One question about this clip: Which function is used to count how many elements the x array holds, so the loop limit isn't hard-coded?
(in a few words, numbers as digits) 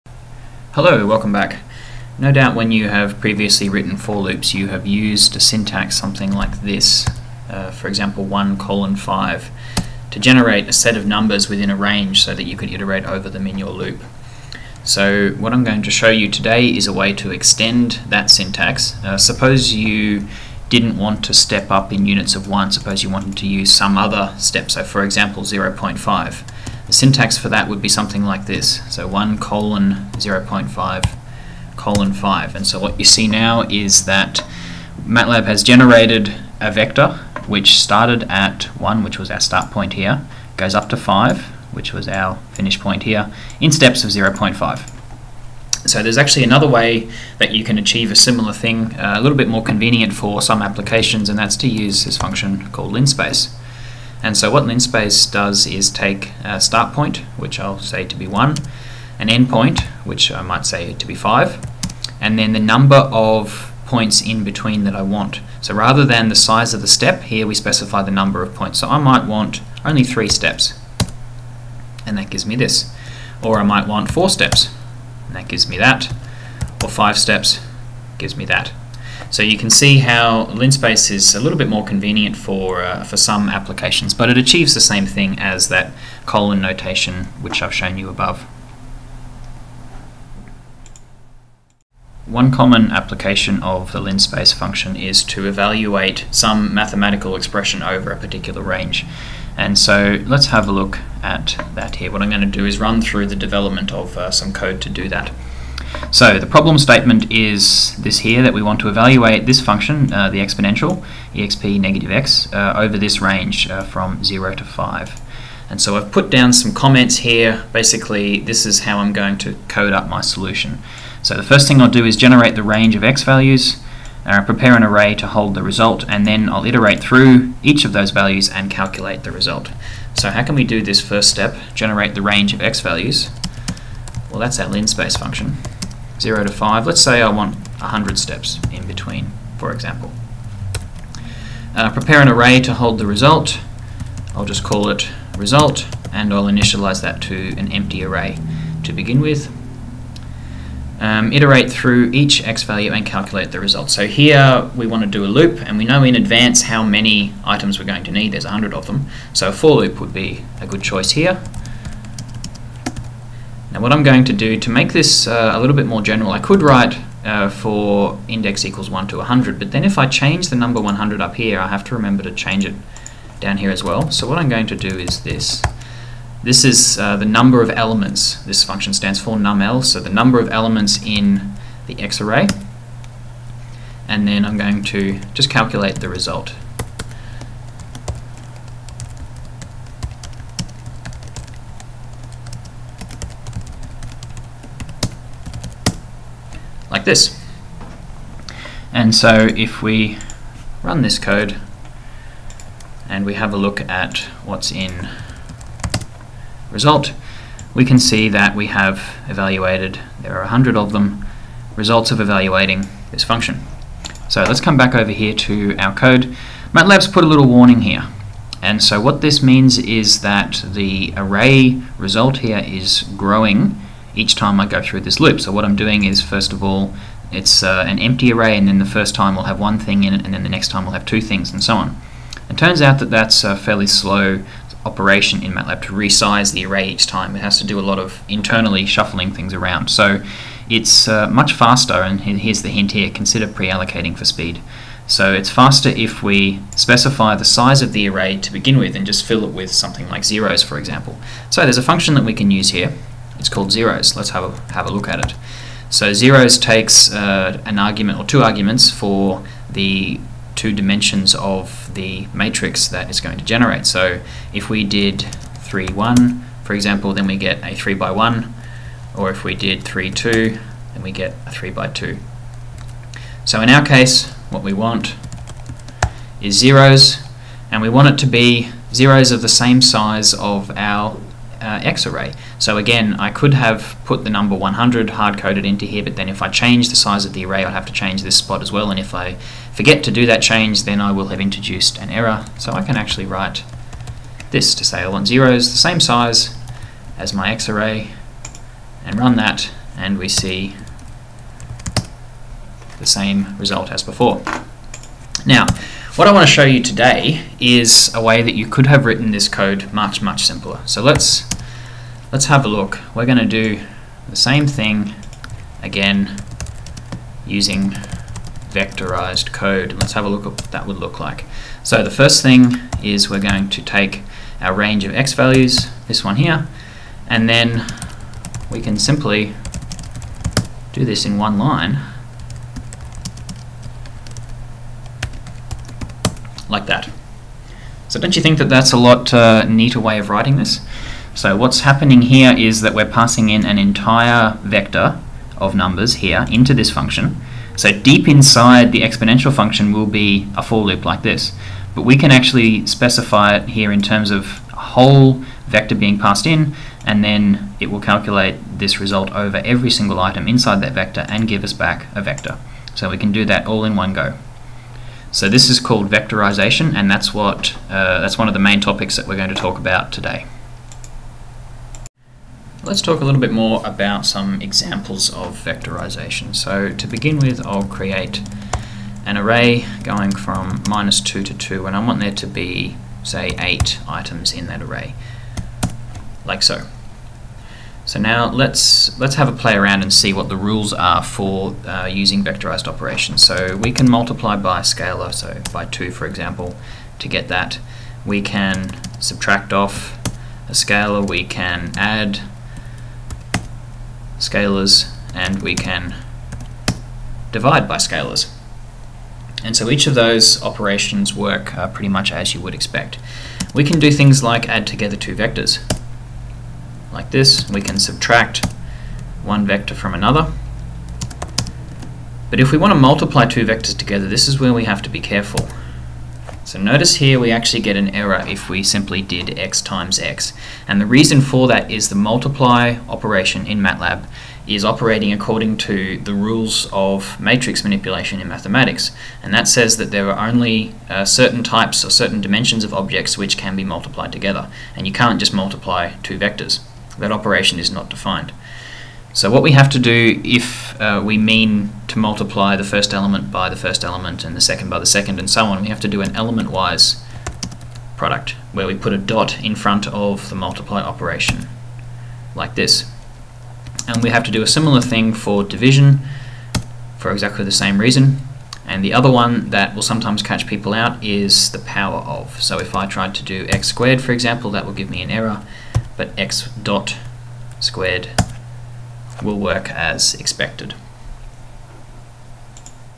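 numel.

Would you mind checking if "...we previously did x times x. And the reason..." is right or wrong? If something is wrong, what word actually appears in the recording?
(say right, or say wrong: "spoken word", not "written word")
wrong: "simply", not "previously".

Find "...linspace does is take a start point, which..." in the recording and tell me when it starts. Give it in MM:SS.
00:54.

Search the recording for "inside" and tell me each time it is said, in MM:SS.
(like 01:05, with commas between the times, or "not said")
05:48, 06:00.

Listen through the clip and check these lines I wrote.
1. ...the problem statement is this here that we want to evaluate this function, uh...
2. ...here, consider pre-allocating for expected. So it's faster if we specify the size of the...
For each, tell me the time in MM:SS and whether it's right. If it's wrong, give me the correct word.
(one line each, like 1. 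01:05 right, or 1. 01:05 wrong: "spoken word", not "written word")
1. 01:46 right
2. 04:02 wrong: "speed", not "expected".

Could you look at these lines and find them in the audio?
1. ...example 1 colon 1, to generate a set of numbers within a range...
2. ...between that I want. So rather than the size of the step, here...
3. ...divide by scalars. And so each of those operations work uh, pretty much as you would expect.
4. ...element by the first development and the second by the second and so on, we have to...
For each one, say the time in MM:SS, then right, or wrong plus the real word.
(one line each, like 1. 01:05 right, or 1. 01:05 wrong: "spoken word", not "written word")
1. 00:07 wrong: "5", not "1"
2. 01:04 right
3. 06:47 right
4. 07:33 wrong: "element", not "development".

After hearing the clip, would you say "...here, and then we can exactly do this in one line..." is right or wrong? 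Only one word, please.
wrong.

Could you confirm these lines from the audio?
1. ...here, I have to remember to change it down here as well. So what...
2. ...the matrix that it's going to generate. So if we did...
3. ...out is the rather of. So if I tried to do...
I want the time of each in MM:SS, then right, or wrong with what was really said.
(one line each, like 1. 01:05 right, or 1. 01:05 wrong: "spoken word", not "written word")
1. 02:51 right
2. 04:21 right
3. 07:50 wrong: "power", not "rather".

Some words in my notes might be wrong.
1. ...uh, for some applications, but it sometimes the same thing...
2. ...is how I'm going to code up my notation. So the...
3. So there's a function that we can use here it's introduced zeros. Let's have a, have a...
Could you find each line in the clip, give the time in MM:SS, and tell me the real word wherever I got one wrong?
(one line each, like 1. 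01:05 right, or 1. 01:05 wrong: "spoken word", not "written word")
1. 01:22 wrong: "achieves", not "sometimes"
2. 01:58 wrong: "solution", not "notation"
3. 04:11 wrong: "called", not "introduced".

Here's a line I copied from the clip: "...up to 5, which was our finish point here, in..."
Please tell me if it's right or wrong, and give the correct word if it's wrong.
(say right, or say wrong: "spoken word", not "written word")
right.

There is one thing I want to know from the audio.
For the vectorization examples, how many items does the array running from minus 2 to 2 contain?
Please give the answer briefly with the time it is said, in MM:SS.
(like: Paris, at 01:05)
8, at 06:23.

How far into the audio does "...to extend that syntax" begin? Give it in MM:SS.
00:17.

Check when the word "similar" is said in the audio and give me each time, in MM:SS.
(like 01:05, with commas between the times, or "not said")
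00:48, 07:44.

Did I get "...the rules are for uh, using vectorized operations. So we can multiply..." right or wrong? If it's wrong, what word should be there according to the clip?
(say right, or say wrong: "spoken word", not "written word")
right.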